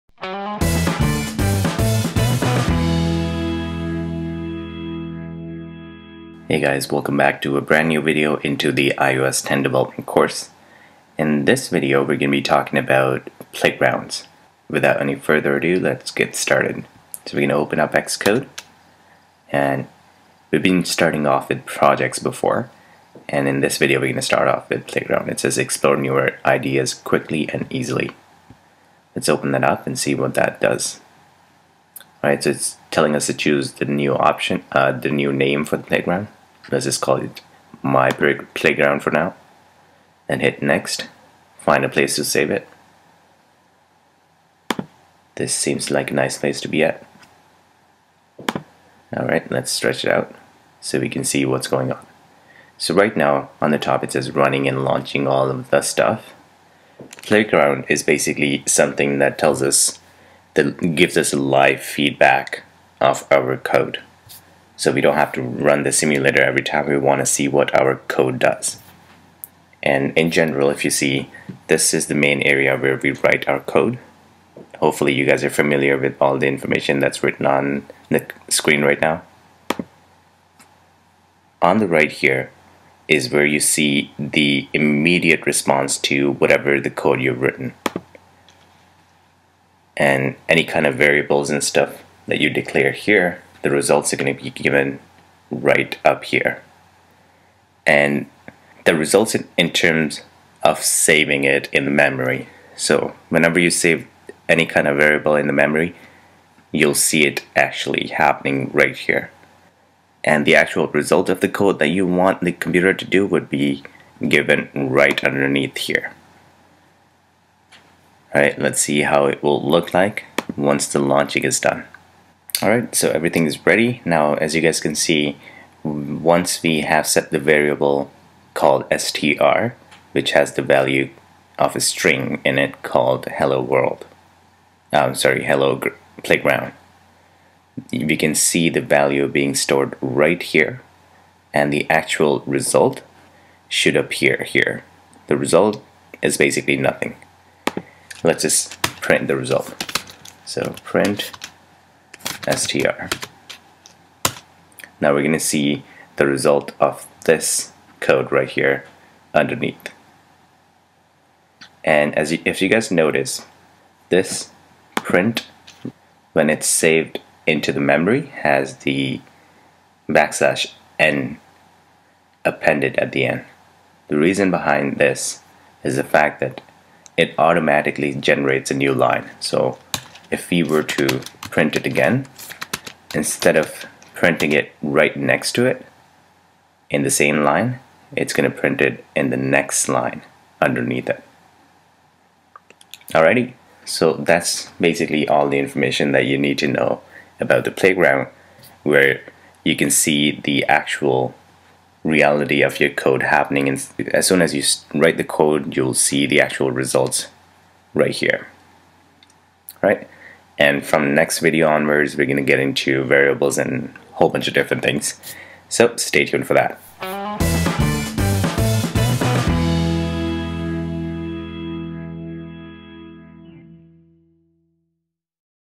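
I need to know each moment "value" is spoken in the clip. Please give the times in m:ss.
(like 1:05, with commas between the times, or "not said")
2:10, 2:18.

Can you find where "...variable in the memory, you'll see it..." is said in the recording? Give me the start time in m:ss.
1:44.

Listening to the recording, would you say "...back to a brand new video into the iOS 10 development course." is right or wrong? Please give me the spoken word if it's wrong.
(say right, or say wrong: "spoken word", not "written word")
right.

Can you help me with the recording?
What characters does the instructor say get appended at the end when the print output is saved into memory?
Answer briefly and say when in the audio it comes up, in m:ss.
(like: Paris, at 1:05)
backslash n, at 2:50.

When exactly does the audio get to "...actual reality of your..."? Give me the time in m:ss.
3:20.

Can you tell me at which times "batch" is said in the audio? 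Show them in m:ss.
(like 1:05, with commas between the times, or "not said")
not said.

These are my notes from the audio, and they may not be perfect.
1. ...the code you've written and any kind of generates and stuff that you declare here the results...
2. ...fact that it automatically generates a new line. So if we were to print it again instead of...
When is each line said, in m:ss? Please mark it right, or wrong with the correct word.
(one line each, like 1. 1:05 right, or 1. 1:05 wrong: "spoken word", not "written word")
1. 1:26 wrong: "variables", not "generates"
2. 2:56 right.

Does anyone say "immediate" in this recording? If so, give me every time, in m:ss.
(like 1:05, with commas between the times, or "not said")
1:24.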